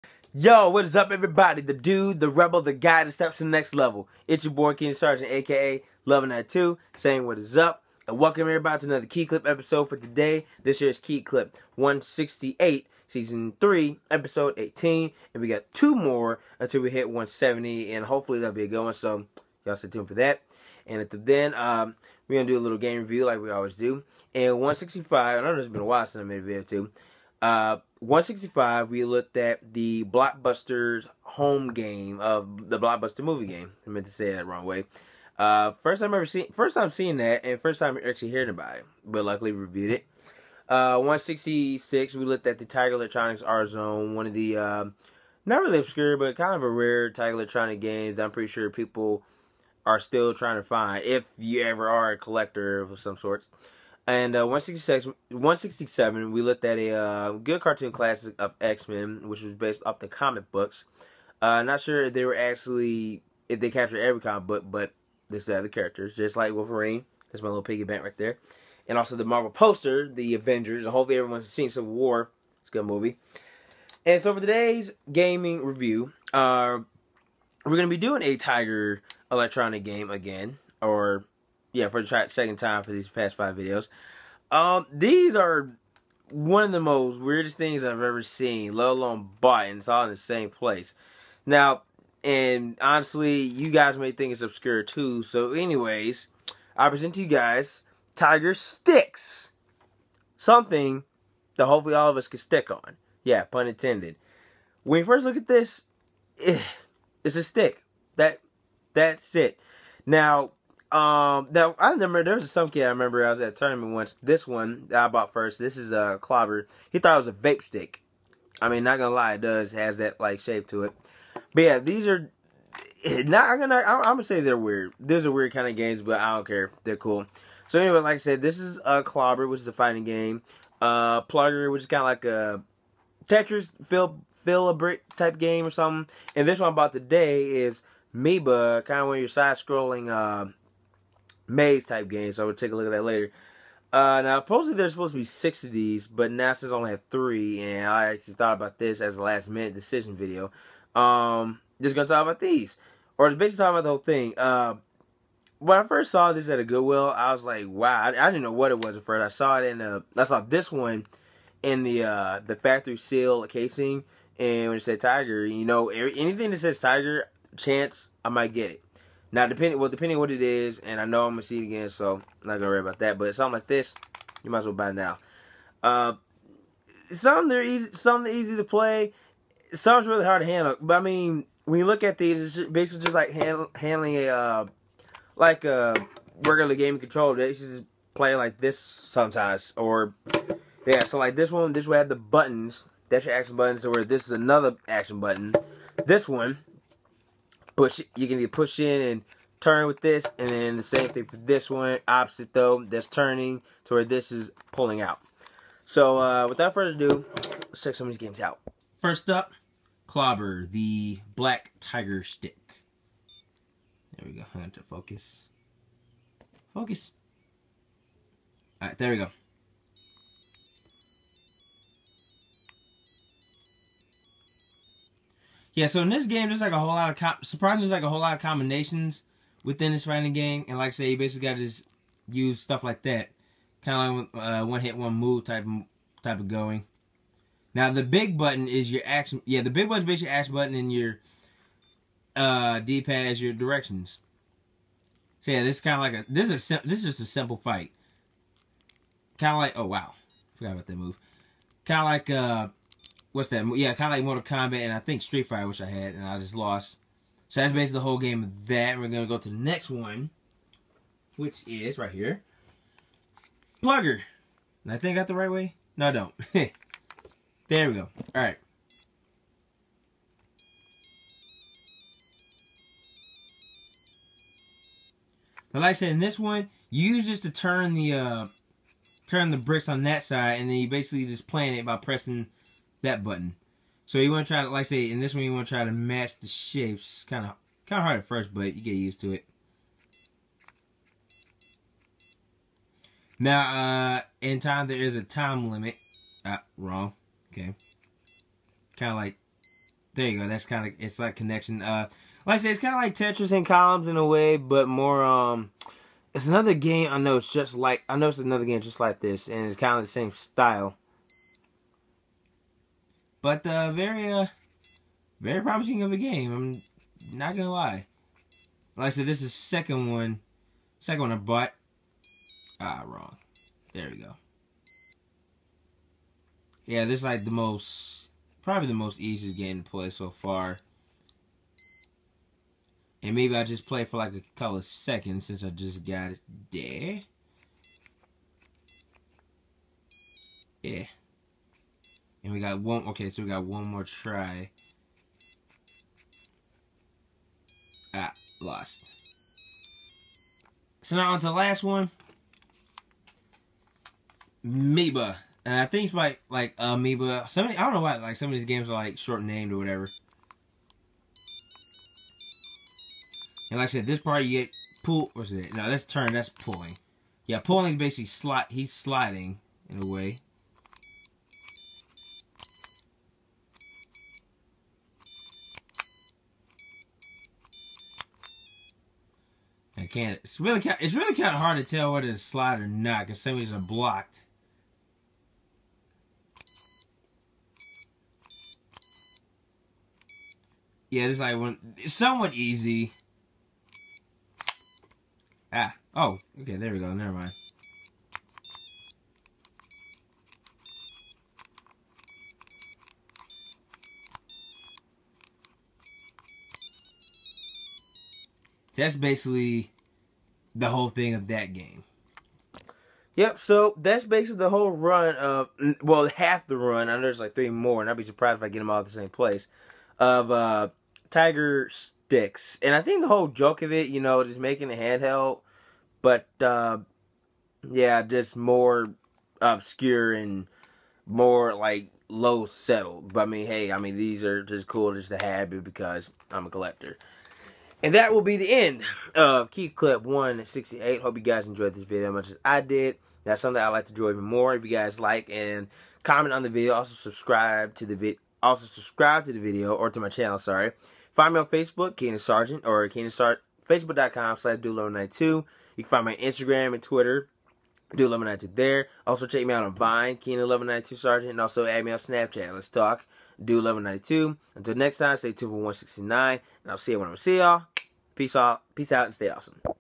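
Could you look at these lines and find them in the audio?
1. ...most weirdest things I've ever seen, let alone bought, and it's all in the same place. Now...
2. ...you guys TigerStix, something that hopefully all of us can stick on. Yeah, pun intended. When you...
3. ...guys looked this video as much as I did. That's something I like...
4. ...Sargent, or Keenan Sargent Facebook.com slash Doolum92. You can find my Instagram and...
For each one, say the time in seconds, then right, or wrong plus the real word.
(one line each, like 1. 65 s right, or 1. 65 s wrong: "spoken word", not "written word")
1. 86 s right
2. 97 s right
3. 441 s wrong: "enjoyed", not "looked"
4. 452 s right.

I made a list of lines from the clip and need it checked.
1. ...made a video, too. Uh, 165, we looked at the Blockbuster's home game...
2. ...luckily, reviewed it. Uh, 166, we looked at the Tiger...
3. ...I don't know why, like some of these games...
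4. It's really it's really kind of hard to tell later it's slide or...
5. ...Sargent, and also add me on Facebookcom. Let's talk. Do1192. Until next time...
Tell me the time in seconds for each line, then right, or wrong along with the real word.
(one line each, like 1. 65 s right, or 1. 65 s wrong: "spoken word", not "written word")
1. 26 s right
2. 39 s right
3. 357 s right
4. 380 s wrong: "whether", not "later"
5. 461 s wrong: "Snapchat", not "Facebookcom".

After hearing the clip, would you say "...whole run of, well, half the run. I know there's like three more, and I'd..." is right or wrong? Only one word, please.
right.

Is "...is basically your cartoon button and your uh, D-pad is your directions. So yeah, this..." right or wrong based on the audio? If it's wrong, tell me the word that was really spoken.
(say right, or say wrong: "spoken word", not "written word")
wrong: "action", not "cartoon".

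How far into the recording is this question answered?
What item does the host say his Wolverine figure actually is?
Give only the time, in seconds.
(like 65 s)
67 s.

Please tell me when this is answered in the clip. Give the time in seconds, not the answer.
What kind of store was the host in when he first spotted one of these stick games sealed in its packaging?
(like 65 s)
156 s.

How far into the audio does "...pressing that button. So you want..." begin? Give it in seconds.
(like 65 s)
281 s.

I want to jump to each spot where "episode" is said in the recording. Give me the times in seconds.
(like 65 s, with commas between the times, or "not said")
9 s, 14 s.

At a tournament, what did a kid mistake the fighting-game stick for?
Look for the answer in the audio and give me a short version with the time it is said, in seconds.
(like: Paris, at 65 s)
A vape stick, at 117 s.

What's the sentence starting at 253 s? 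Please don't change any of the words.
Yeah, kind of like Mortal Kombat, and I think Street Fighter, which I had, and I just lost.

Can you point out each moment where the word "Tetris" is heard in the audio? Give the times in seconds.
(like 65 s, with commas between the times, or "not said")
133 s, 303 s.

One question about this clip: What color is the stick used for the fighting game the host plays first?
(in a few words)
Black.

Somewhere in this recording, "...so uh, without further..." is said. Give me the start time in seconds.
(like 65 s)
205 s.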